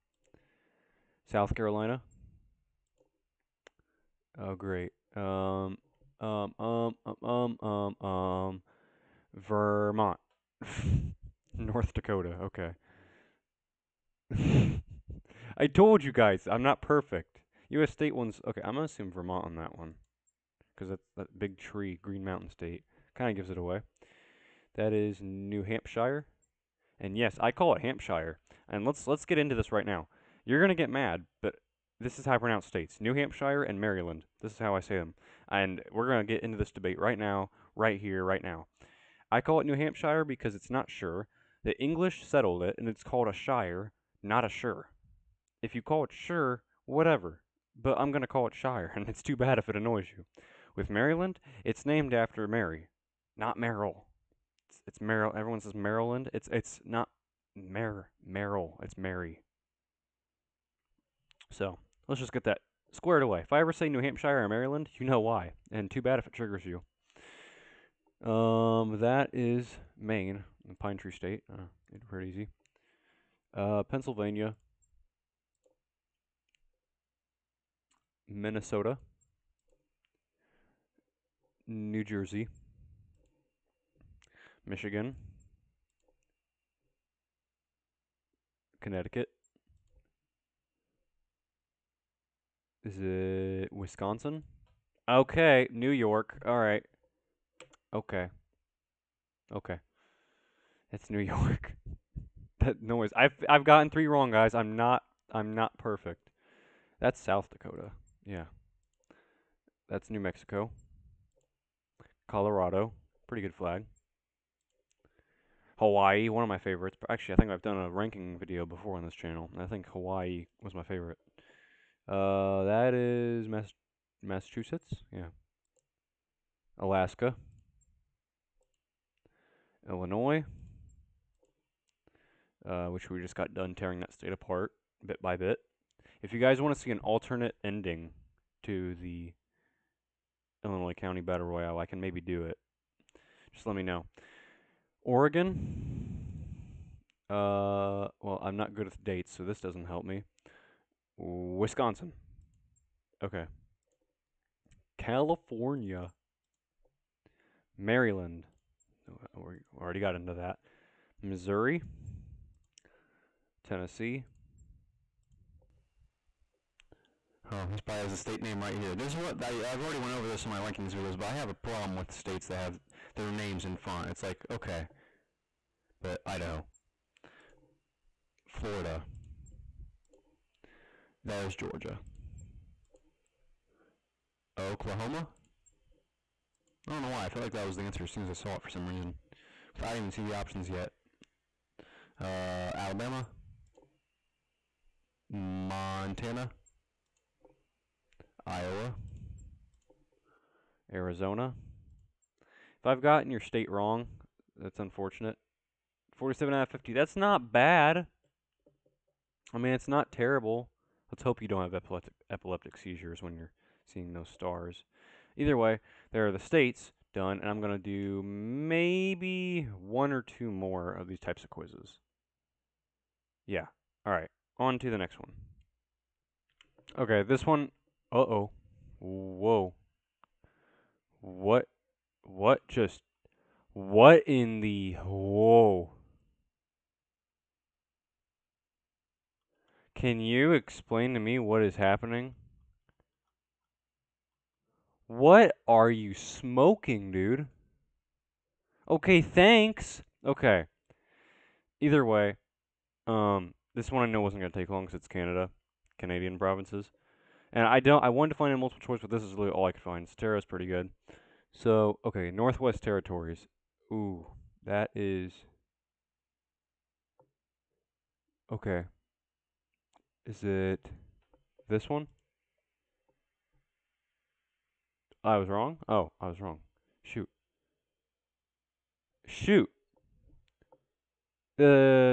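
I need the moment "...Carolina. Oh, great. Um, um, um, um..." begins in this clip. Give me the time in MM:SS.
00:01.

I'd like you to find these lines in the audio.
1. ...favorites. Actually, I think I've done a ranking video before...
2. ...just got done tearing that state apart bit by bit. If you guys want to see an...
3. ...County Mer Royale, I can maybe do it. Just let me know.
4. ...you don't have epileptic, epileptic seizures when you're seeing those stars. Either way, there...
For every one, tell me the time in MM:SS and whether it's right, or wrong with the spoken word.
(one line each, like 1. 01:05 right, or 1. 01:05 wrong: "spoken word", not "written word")
1. 01:56 right
2. 02:13 right
3. 02:20 wrong: "Battle", not "Mer"
4. 03:31 right.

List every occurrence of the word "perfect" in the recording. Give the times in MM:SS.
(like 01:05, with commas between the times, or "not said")
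00:16, 01:45.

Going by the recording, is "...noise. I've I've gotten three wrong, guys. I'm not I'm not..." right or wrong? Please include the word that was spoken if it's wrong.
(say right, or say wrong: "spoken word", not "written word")
right.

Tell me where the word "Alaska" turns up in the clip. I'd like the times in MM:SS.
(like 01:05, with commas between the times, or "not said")
02:06.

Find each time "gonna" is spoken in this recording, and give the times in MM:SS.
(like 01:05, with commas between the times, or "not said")
04:14.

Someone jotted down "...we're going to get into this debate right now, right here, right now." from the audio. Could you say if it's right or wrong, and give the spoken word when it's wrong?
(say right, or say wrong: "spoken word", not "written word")
right.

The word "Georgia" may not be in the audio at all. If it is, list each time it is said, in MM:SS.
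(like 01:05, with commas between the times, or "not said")
03:01.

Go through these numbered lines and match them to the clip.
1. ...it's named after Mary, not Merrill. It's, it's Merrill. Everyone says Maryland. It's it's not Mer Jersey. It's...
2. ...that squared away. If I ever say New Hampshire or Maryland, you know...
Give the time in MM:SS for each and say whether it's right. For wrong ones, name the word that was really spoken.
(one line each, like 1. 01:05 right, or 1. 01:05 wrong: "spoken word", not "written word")
1. 00:51 wrong: "Merrill", not "Jersey"
2. 01:02 right.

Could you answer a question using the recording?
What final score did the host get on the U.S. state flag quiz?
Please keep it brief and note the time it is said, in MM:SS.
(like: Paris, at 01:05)
47 out of 50, at 03:26.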